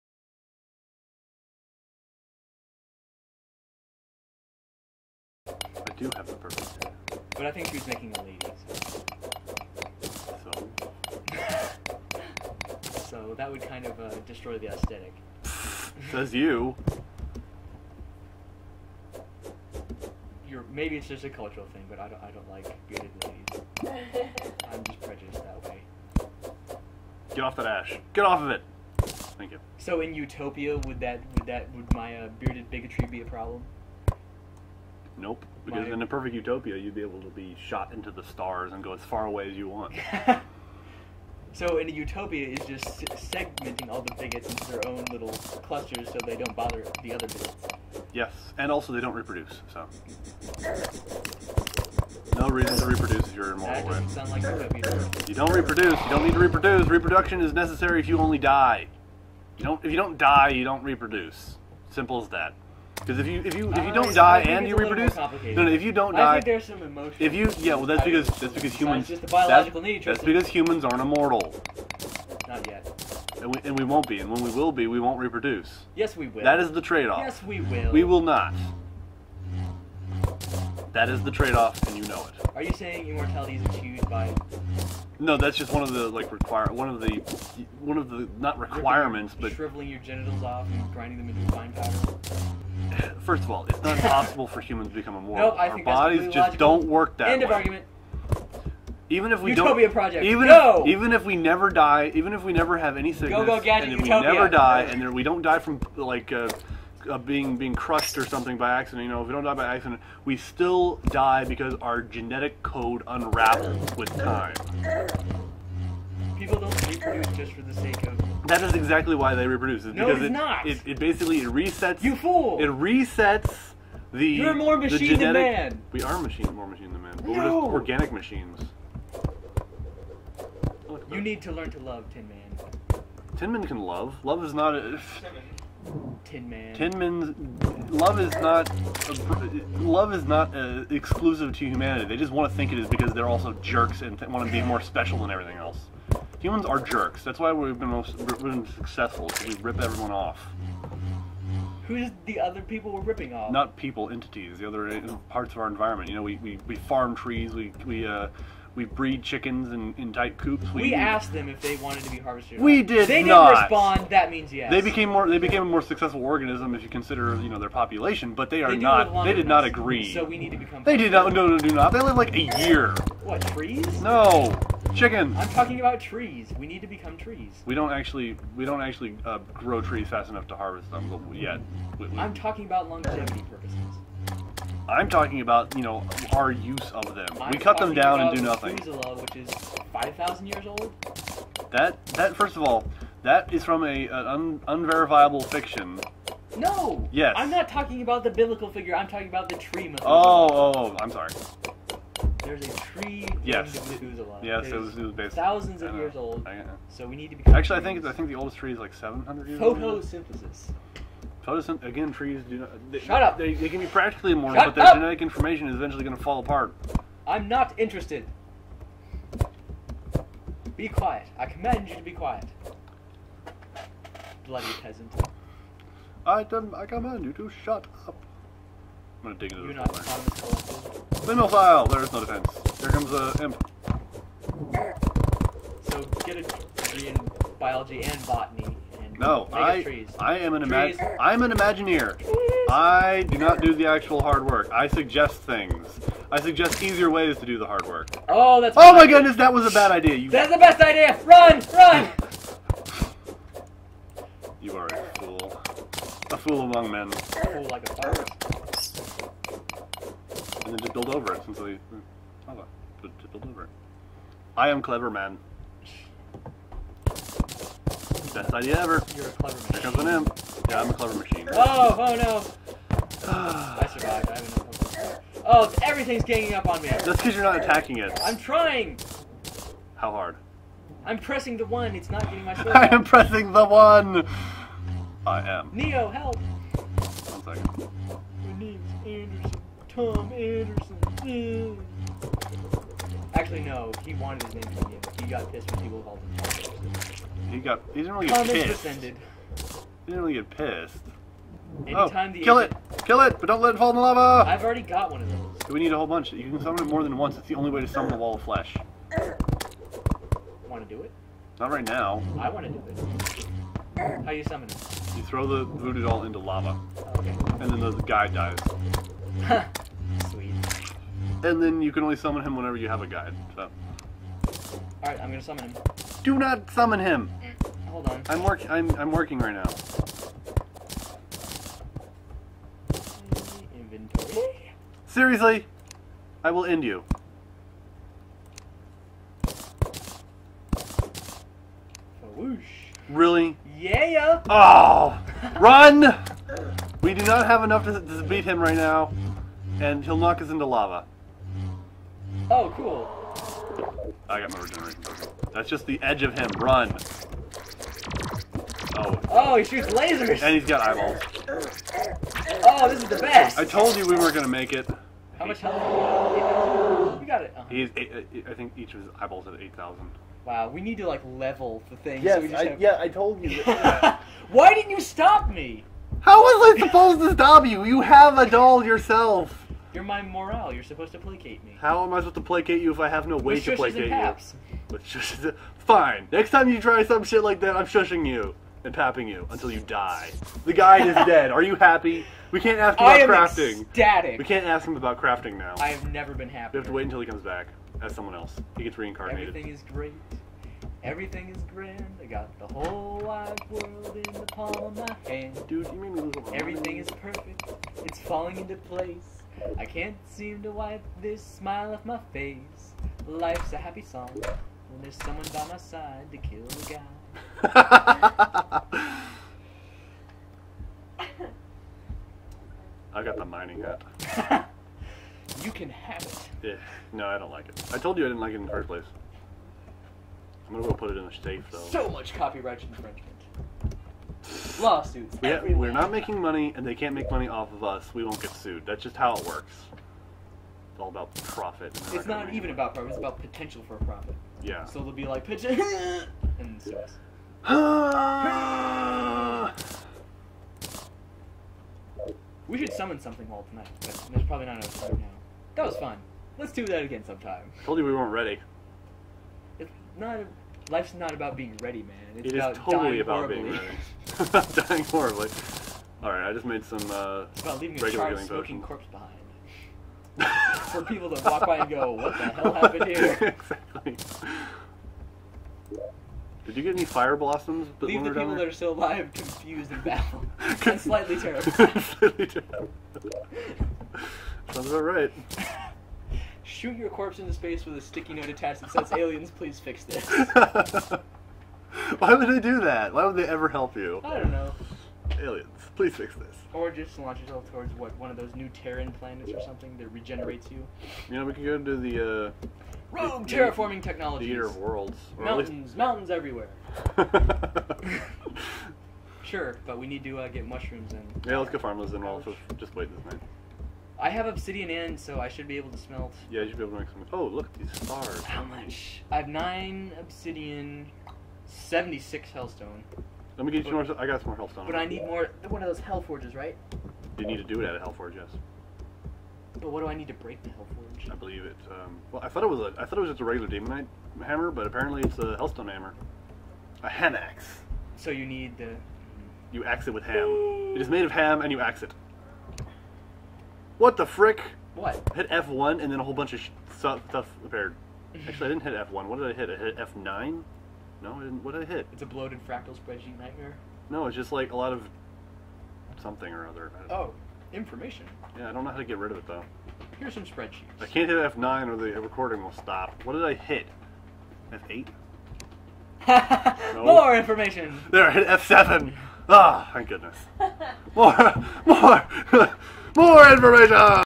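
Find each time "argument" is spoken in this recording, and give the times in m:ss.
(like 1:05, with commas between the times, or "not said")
1:37.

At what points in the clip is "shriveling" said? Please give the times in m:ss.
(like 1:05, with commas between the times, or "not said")
1:29.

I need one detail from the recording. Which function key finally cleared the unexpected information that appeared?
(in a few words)
F7.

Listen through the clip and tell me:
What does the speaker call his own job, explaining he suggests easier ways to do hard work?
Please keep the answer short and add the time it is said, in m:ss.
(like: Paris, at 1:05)
Imagineer, at 4:01.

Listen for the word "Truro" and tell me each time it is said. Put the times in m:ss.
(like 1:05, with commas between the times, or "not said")
not said.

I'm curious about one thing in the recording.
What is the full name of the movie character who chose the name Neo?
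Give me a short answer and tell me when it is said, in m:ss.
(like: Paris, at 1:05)
Tom Anderson, at 4:49.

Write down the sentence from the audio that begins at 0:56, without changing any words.
Reproduction is necessary if you only die.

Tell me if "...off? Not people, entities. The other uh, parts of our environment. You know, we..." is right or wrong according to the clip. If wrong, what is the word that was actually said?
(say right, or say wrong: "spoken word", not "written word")
right.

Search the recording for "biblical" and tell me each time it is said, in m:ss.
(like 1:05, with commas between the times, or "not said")
3:18.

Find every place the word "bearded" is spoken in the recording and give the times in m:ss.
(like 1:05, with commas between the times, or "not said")
0:22, 0:32.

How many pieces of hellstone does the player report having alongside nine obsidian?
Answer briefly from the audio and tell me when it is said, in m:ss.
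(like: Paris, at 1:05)
76, at 8:41.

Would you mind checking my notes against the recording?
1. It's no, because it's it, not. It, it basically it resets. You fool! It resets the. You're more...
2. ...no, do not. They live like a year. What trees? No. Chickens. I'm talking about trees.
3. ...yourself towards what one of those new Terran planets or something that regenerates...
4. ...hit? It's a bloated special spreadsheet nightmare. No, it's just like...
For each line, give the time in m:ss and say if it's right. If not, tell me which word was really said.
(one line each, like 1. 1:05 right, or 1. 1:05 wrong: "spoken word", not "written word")
1. 1:59 right
2. 2:51 right
3. 8:17 right
4. 9:11 wrong: "fractal", not "special".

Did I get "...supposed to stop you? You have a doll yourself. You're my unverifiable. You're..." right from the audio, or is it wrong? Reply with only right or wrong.
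wrong.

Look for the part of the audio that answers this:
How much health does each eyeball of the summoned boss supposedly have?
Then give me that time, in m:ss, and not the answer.
6:09.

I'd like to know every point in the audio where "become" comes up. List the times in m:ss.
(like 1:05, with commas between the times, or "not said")
1:34, 2:50, 2:56.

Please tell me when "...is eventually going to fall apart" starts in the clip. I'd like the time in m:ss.
3:35.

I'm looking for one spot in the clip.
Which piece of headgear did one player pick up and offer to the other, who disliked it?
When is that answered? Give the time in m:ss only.
7:03.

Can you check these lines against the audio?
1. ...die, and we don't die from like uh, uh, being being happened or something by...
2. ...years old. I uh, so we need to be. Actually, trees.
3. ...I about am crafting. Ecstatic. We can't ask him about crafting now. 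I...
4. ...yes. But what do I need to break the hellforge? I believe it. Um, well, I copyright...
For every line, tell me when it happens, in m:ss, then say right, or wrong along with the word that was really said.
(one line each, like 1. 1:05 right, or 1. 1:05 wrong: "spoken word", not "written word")
1. 1:44 wrong: "crushed", not "happened"
2. 3:25 right
3. 6:33 right
4. 8:48 wrong: "thought", not "copyright".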